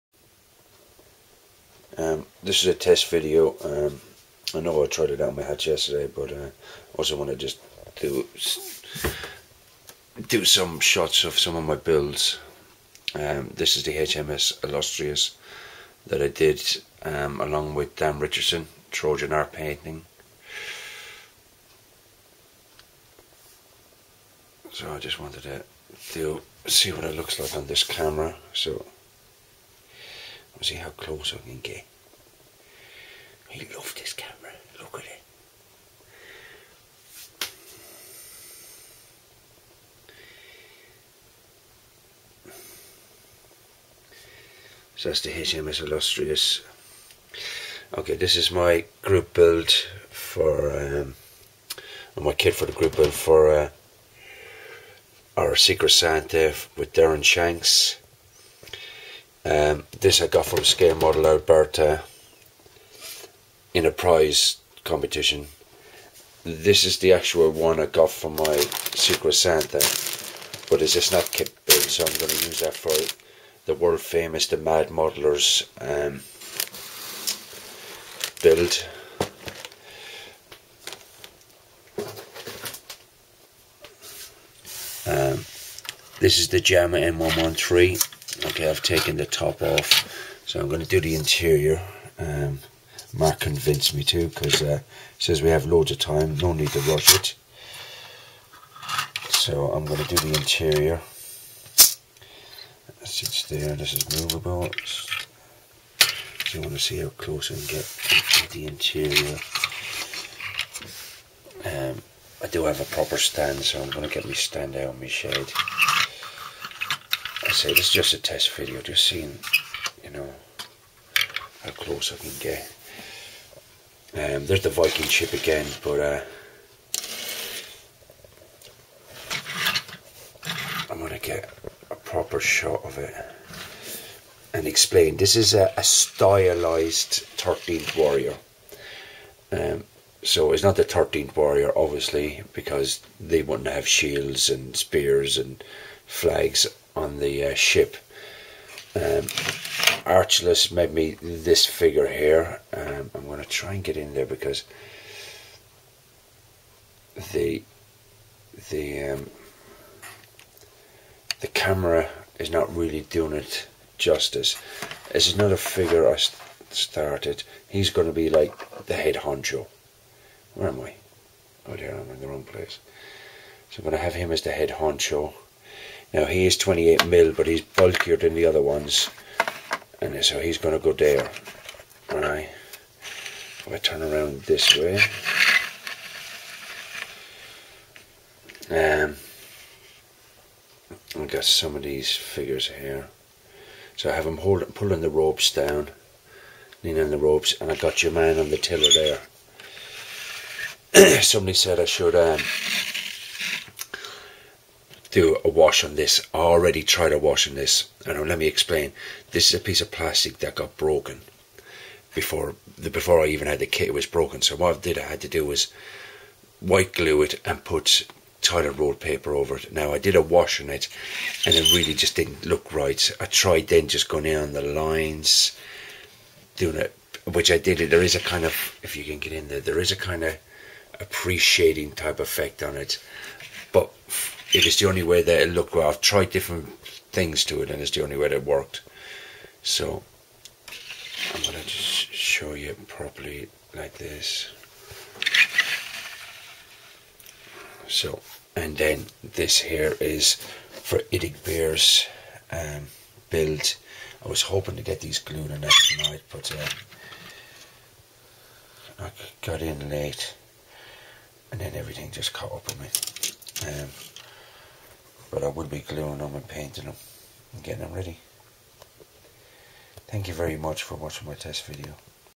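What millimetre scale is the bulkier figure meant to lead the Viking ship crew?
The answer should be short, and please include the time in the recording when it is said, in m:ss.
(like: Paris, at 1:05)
28, at 2:56.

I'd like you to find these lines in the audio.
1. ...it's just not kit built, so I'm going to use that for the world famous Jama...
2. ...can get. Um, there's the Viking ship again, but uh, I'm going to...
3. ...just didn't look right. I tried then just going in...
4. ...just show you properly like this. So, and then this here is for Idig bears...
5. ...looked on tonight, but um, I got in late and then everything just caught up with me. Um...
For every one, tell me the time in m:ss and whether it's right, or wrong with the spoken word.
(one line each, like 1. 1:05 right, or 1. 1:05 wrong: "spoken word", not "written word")
1. 1:10 wrong: "The", not "Jama"
2. 2:02 right
3. 3:41 right
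4. 4:01 right
5. 4:15 wrong: "glued", not "looked".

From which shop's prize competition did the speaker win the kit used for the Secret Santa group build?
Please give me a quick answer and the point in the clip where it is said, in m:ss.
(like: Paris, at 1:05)
Scale Model Alberta, at 1:00.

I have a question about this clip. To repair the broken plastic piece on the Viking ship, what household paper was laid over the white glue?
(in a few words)
toilet roll paper.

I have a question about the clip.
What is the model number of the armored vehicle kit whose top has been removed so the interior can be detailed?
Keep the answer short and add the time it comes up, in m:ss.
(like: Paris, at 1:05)
M113, at 1:26.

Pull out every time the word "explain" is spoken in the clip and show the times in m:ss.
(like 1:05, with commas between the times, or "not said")
2:14, 3:28.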